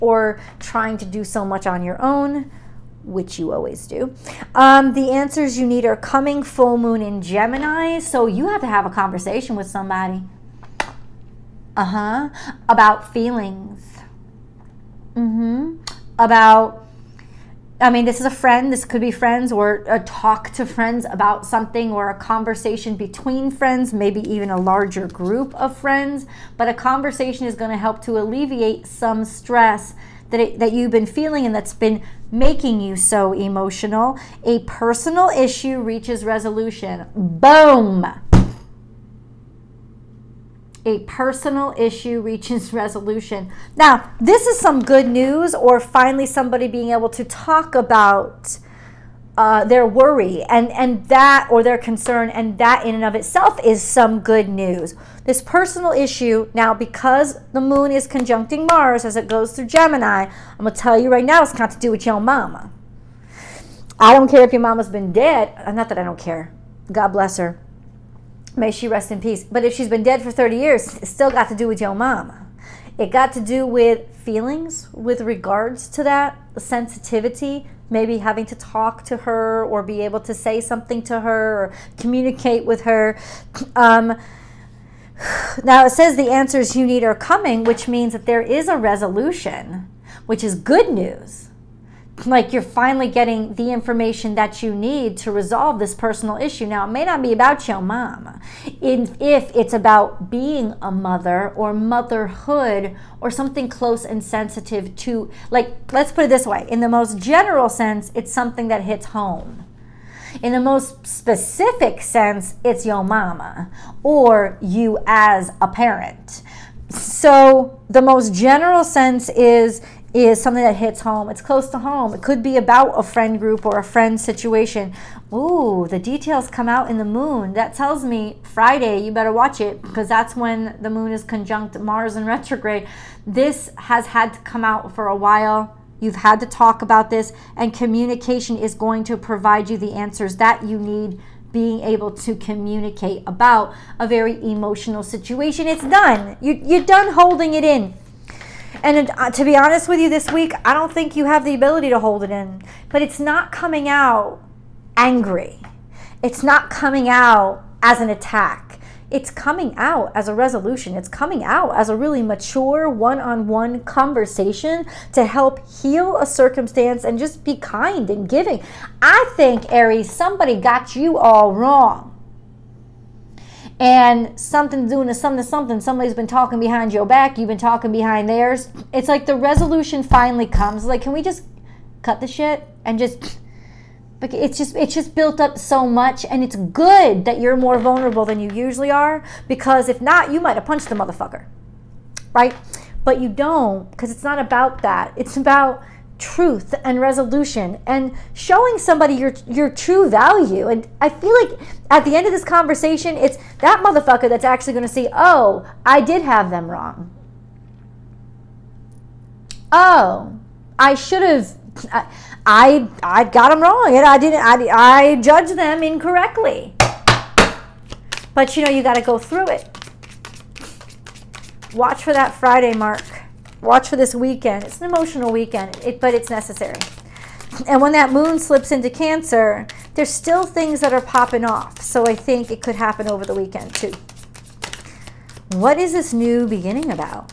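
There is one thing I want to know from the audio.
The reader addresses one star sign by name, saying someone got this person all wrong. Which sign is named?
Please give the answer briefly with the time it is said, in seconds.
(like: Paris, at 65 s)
Aries, at 169 s.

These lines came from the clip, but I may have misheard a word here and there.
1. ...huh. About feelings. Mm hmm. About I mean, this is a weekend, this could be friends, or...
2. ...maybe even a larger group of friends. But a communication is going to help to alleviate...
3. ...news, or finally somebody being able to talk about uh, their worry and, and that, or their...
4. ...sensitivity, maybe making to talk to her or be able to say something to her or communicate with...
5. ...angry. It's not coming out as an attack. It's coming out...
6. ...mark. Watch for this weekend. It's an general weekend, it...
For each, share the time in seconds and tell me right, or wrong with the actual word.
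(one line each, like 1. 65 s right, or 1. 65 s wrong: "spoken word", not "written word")
1. 11 s wrong: "friend", not "weekend"
2. 23 s wrong: "conversation", not "communication"
3. 45 s right
4. 76 s wrong: "having", not "making"
5. 154 s right
6. 222 s wrong: "emotional", not "general".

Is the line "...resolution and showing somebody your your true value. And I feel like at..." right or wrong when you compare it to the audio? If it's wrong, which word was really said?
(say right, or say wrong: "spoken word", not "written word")
right.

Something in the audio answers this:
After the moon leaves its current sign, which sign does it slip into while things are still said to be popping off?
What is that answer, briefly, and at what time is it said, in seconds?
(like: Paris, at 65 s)
Cancer, at 228 s.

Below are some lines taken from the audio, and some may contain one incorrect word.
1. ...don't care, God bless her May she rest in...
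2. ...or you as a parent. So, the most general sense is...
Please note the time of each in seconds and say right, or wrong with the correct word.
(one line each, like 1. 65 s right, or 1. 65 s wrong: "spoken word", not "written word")
1. 66 s right
2. 114 s right.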